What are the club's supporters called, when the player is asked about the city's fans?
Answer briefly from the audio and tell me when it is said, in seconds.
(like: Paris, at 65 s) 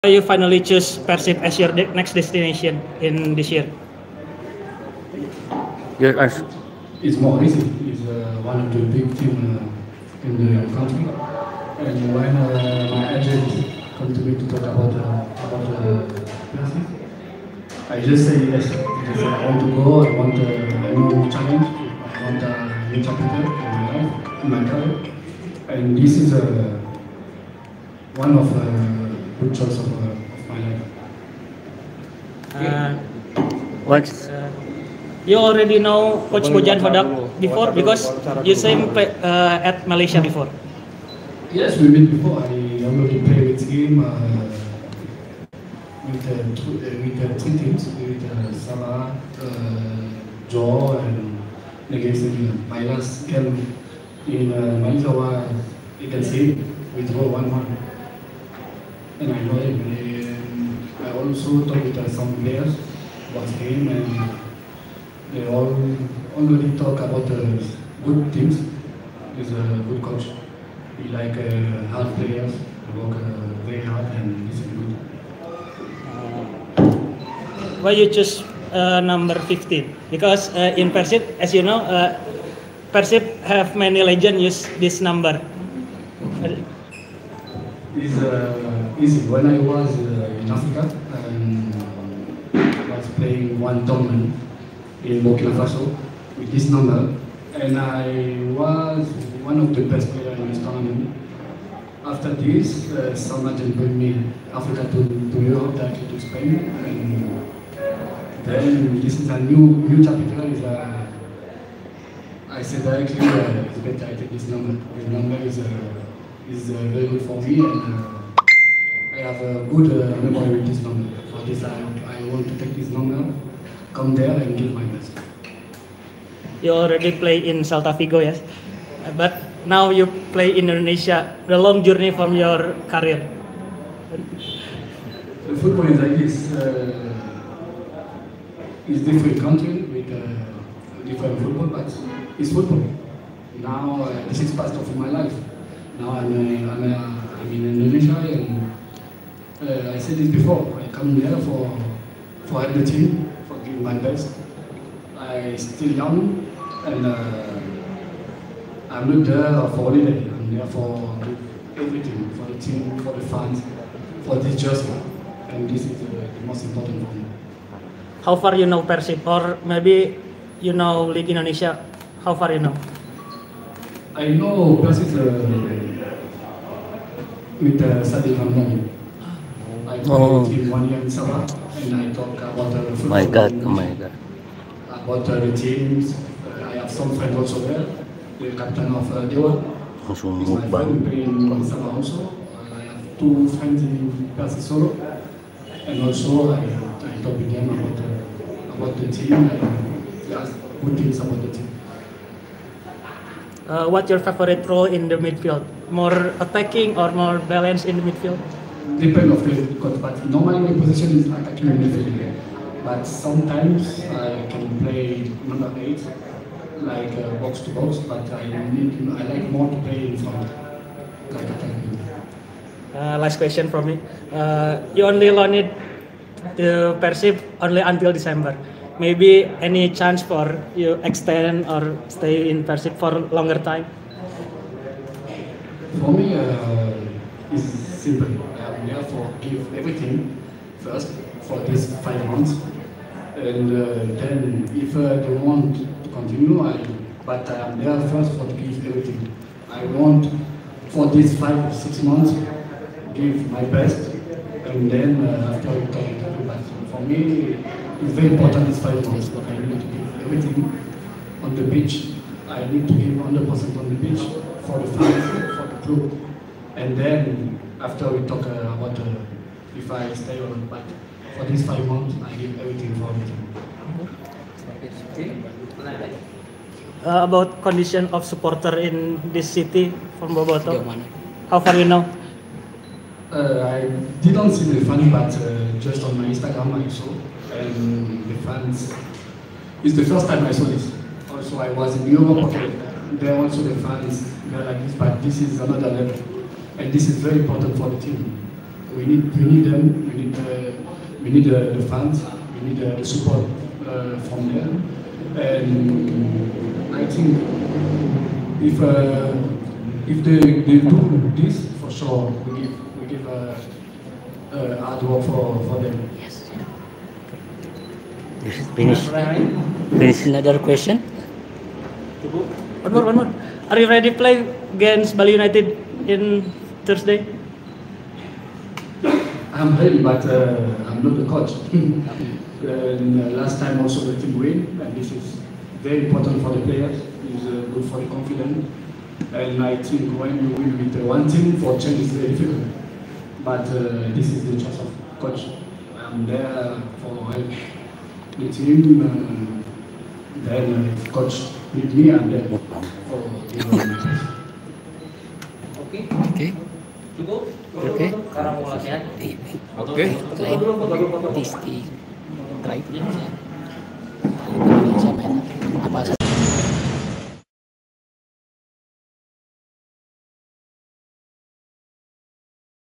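Bobotoh, at 280 s.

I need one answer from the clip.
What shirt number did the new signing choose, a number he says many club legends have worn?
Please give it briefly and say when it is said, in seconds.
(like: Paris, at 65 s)
15, at 79 s.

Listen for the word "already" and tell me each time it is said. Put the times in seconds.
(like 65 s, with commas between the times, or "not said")
35 s, 42 s, 66 s, 126 s.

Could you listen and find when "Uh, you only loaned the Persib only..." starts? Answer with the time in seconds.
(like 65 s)
224 s.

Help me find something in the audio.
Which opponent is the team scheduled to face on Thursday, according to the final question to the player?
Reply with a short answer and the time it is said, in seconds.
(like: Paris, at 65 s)
Bali United, at 325 s.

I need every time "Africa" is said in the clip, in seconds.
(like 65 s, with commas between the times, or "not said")
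90 s, 104 s.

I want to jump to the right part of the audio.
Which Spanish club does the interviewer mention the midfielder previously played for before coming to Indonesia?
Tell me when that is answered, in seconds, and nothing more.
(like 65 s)
127 s.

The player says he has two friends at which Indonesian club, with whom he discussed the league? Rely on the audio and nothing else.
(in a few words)
Persis Solo.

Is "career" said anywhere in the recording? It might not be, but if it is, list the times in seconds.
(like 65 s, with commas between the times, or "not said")
24 s, 132 s.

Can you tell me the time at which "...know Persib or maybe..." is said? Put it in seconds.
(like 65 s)
168 s.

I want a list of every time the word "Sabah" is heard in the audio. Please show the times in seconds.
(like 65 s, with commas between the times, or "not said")
181 s, 191 s.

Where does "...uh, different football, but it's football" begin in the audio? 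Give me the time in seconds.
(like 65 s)
140 s.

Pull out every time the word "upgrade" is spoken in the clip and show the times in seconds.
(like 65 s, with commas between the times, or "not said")
not said.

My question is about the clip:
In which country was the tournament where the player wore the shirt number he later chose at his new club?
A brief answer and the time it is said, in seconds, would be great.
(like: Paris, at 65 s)
Burkina Faso, at 95 s.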